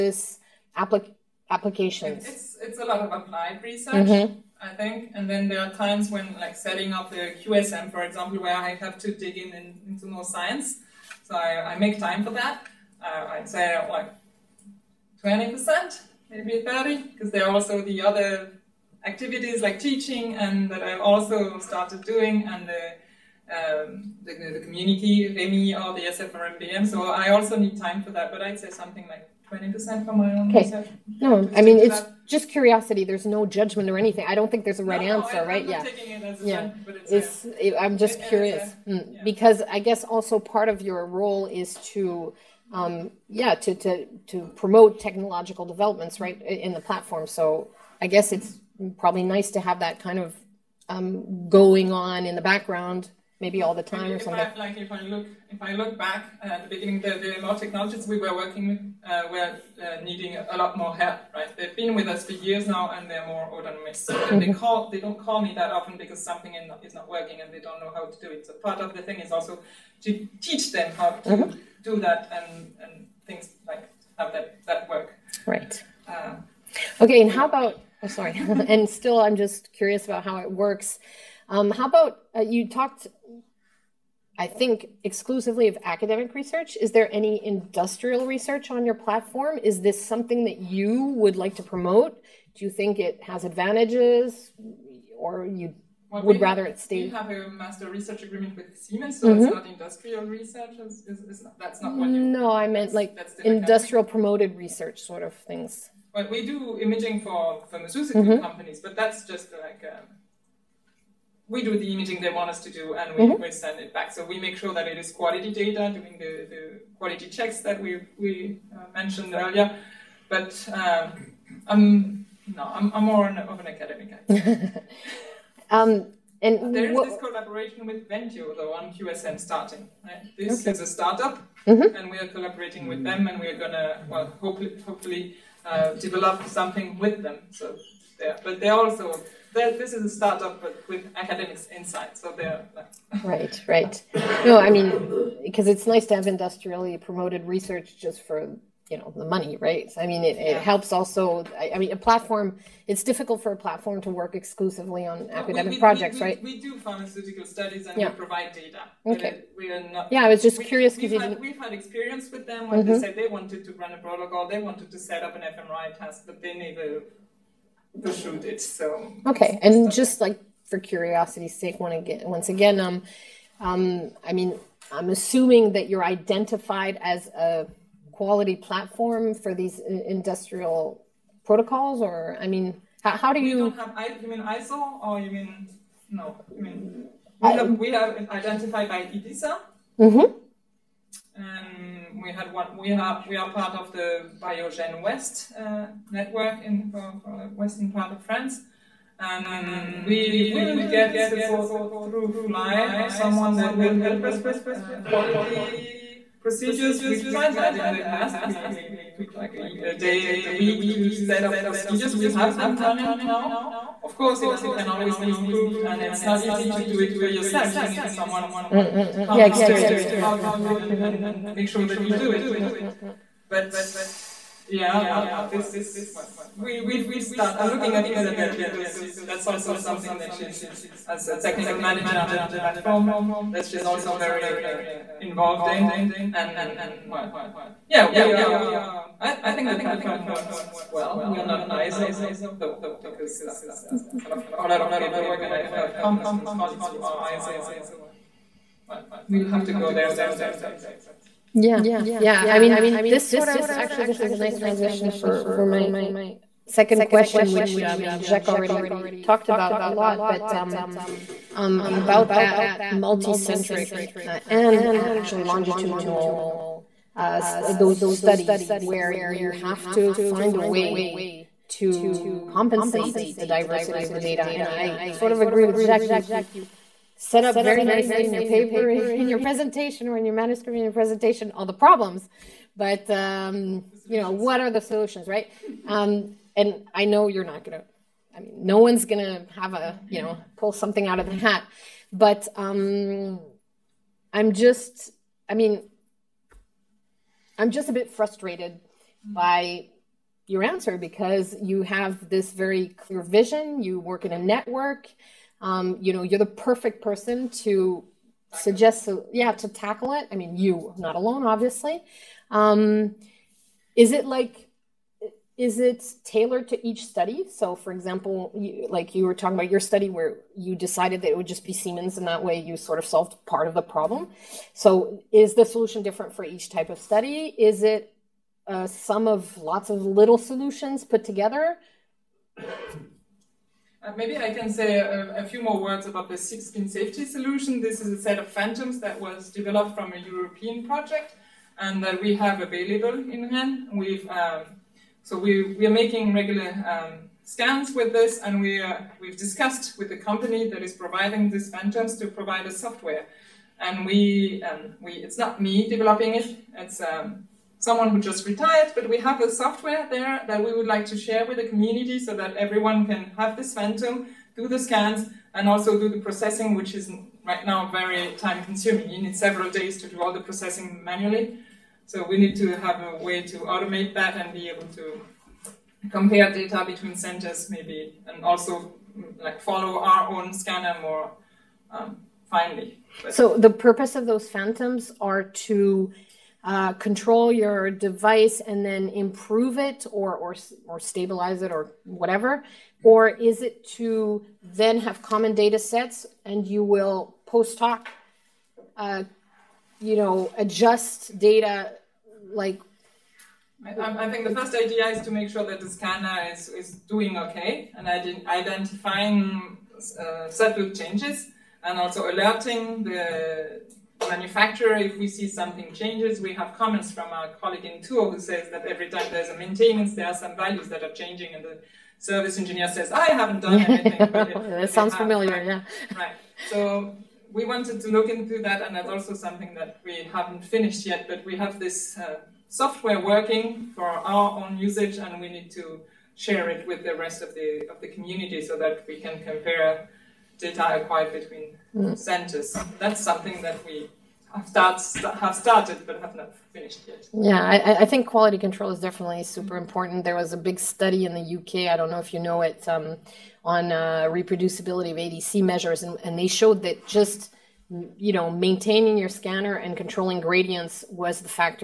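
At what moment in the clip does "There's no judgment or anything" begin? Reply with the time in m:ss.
0:33.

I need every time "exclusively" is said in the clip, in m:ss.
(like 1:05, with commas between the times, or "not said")
1:25, 2:34.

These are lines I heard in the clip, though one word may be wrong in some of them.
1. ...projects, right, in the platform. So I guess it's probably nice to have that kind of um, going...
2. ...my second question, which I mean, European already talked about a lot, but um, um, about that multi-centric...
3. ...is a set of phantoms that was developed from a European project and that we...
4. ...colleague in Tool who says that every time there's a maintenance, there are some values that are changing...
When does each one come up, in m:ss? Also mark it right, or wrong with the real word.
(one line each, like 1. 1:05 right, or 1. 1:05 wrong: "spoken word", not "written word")
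1. 0:45 wrong: "developments", not "projects"
2. 4:15 wrong: "Jacques", not "European"
3. 5:38 right
4. 6:57 right.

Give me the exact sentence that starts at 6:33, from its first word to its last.
Or is it to then have common data sets and you will post hoc, uh, you know, adjust data like?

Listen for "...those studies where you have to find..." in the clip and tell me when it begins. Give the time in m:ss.
4:27.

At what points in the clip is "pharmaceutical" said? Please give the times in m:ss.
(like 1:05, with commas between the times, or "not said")
1:47, 2:36.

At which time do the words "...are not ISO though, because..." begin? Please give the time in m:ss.
4:01.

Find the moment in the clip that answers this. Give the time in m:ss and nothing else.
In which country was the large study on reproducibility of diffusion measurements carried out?
7:31.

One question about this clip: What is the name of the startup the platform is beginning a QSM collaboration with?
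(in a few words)
Ventio.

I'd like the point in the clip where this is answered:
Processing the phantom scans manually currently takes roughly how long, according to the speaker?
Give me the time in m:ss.
6:09.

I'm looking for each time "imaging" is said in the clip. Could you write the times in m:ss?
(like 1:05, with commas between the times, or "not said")
1:46, 1:51.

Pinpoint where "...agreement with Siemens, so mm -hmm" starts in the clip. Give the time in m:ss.
1:38.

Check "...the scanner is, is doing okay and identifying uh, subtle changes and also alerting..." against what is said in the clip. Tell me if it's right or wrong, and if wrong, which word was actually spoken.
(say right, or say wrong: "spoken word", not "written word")
right.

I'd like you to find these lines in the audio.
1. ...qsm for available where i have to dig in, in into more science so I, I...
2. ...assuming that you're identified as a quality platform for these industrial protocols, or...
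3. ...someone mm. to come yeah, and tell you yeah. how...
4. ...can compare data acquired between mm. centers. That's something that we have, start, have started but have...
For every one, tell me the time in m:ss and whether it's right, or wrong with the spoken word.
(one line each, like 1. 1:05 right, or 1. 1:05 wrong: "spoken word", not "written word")
1. 0:07 wrong: "example", not "available"
2. 2:55 right
3. 3:38 right
4. 7:19 right.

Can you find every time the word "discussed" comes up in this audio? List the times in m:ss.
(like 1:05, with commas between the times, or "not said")
5:49.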